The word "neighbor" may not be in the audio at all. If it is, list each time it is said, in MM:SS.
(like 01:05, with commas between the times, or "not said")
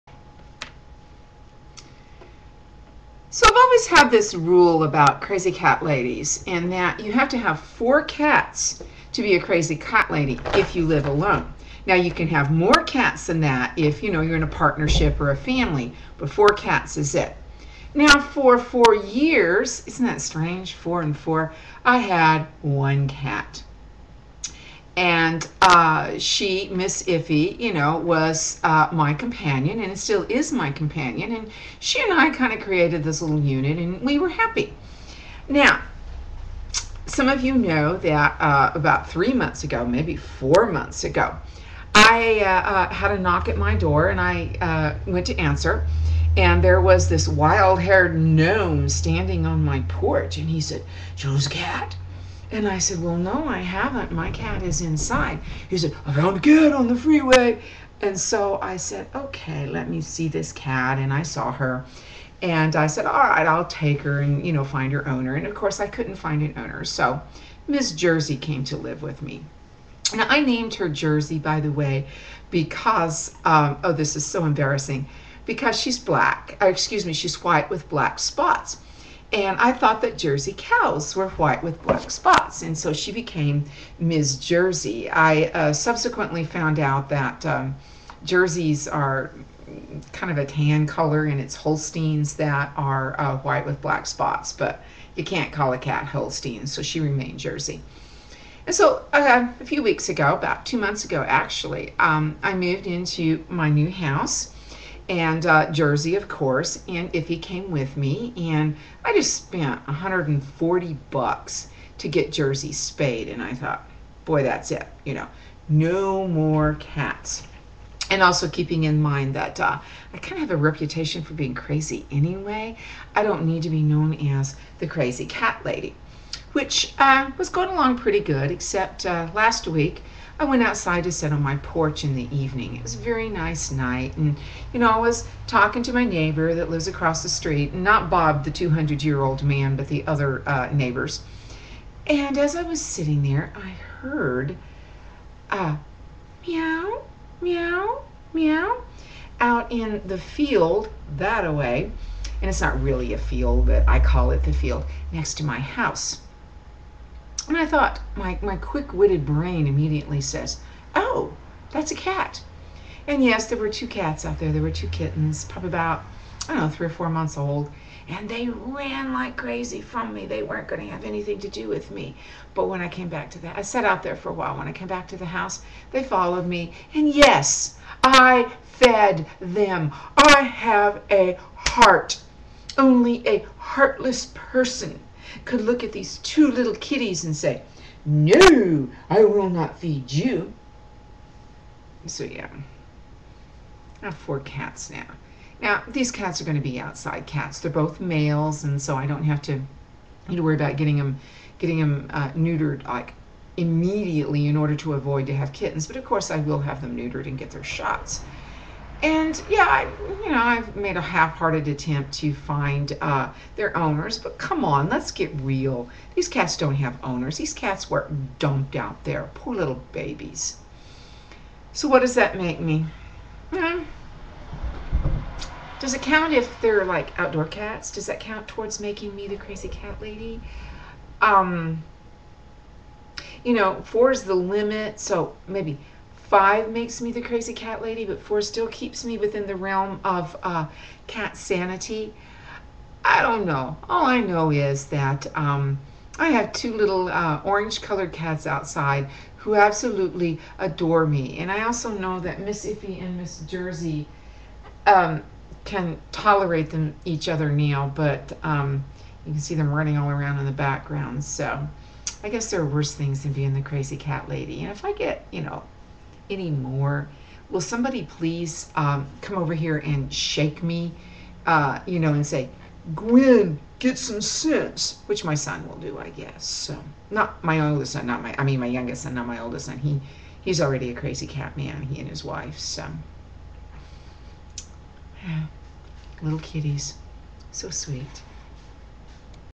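02:16, 02:20.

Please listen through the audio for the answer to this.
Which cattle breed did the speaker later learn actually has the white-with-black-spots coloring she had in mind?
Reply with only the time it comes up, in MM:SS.
01:31.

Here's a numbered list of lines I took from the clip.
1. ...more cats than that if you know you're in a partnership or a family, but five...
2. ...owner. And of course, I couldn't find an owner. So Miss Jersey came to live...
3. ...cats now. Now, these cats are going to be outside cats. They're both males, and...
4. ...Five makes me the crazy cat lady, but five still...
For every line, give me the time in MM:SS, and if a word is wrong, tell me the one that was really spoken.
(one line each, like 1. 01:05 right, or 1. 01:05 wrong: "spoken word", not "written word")
1. 00:12 wrong: "four", not "five"
2. 01:05 right
3. 03:14 right
4. 03:56 wrong: "four", not "five".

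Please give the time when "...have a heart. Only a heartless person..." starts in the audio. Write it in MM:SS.
03:00.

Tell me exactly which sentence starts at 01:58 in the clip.
And also keeping in mind that uh, I kind of have a reputation for being crazy anyway.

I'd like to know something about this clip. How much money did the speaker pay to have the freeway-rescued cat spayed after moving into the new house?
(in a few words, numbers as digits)
$140.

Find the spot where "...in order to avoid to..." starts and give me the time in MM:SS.
03:24.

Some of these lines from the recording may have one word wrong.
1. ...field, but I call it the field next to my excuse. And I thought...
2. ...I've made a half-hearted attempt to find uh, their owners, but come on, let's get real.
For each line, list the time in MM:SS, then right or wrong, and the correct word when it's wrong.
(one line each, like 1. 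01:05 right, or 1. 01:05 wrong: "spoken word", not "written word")
1. 02:33 wrong: "house", not "excuse"
2. 03:30 right.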